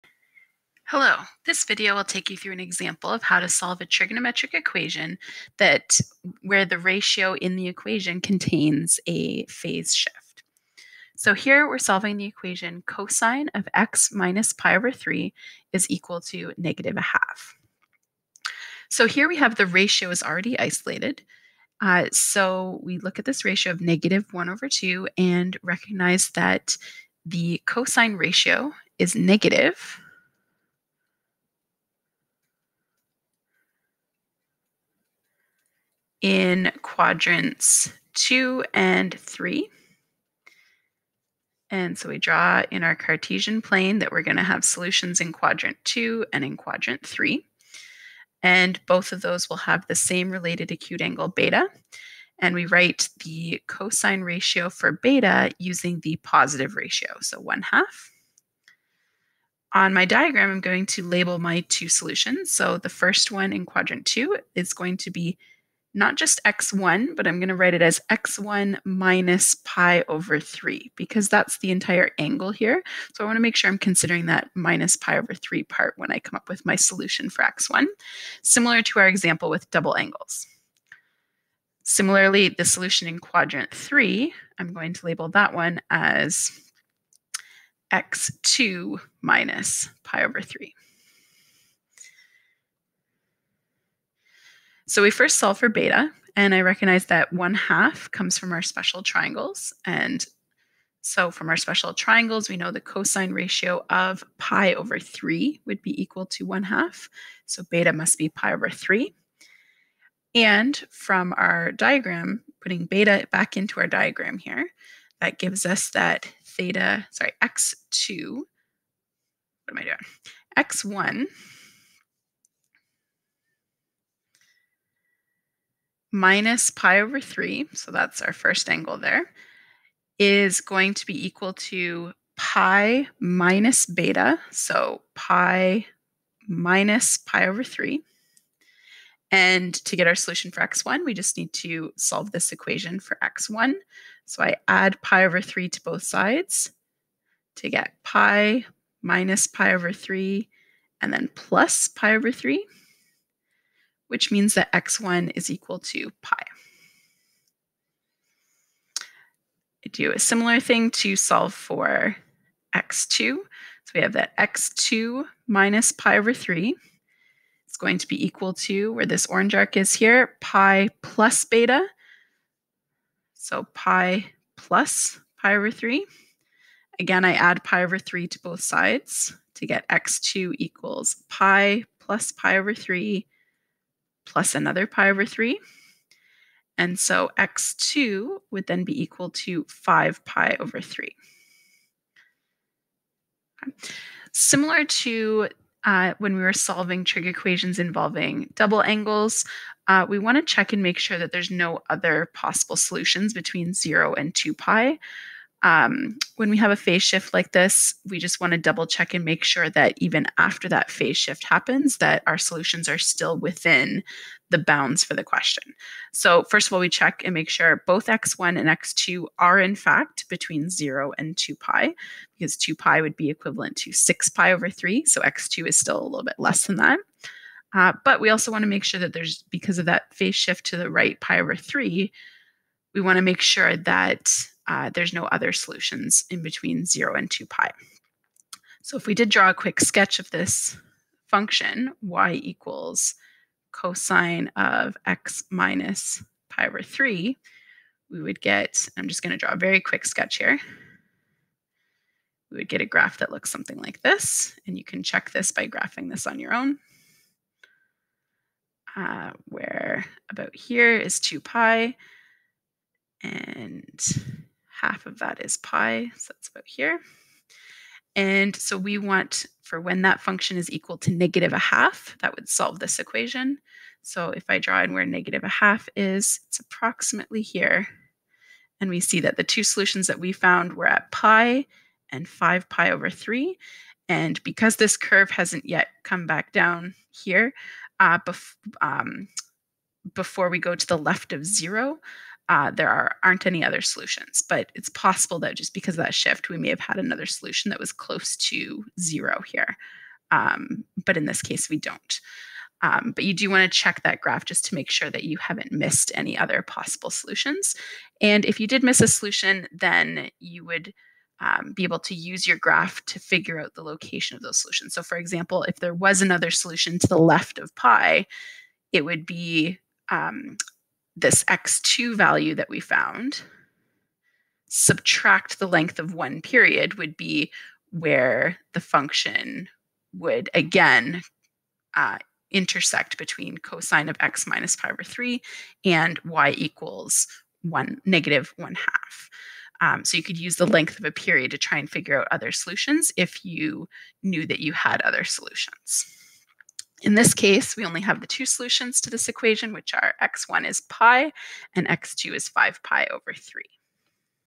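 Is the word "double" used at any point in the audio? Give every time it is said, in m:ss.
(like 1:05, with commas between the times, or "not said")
1:19, 3:18, 3:28.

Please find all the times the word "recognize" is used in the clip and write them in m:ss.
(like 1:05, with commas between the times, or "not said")
0:25, 1:36.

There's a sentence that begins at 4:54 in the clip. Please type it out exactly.
But it's possible that just because of that shift, we may have had another solution that was close to zero here.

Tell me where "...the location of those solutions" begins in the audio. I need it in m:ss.
5:13.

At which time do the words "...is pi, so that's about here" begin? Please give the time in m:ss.
4:25.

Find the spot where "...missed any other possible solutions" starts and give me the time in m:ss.
5:05.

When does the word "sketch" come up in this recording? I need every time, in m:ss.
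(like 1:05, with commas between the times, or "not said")
3:59, 4:10.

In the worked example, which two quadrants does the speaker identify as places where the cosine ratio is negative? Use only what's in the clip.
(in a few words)
Quadrants two and three.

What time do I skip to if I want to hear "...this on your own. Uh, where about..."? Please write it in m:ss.
4:16.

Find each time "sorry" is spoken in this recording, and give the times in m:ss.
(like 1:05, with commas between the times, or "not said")
1:57.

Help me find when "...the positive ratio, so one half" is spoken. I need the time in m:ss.
0:56.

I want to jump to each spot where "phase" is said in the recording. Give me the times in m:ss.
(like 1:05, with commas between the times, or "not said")
0:09, 3:26, 3:30, 3:50.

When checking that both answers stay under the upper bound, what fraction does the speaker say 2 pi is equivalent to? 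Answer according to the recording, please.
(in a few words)
6pi/3.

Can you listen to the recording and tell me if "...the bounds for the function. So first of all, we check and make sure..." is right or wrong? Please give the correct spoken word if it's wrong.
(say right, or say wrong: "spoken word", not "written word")
wrong: "question", not "function".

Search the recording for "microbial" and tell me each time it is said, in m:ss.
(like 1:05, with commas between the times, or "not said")
not said.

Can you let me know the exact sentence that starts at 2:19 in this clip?
And to get our solution for x1, we just need to solve this equation for x1.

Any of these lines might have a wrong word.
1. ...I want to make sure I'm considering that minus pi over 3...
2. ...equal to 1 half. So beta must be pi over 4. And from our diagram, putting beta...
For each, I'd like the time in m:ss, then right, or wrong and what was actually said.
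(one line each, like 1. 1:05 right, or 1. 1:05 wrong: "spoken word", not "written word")
1. 1:13 right
2. 1:46 wrong: "3", not "4".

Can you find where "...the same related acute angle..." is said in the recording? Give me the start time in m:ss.
0:49.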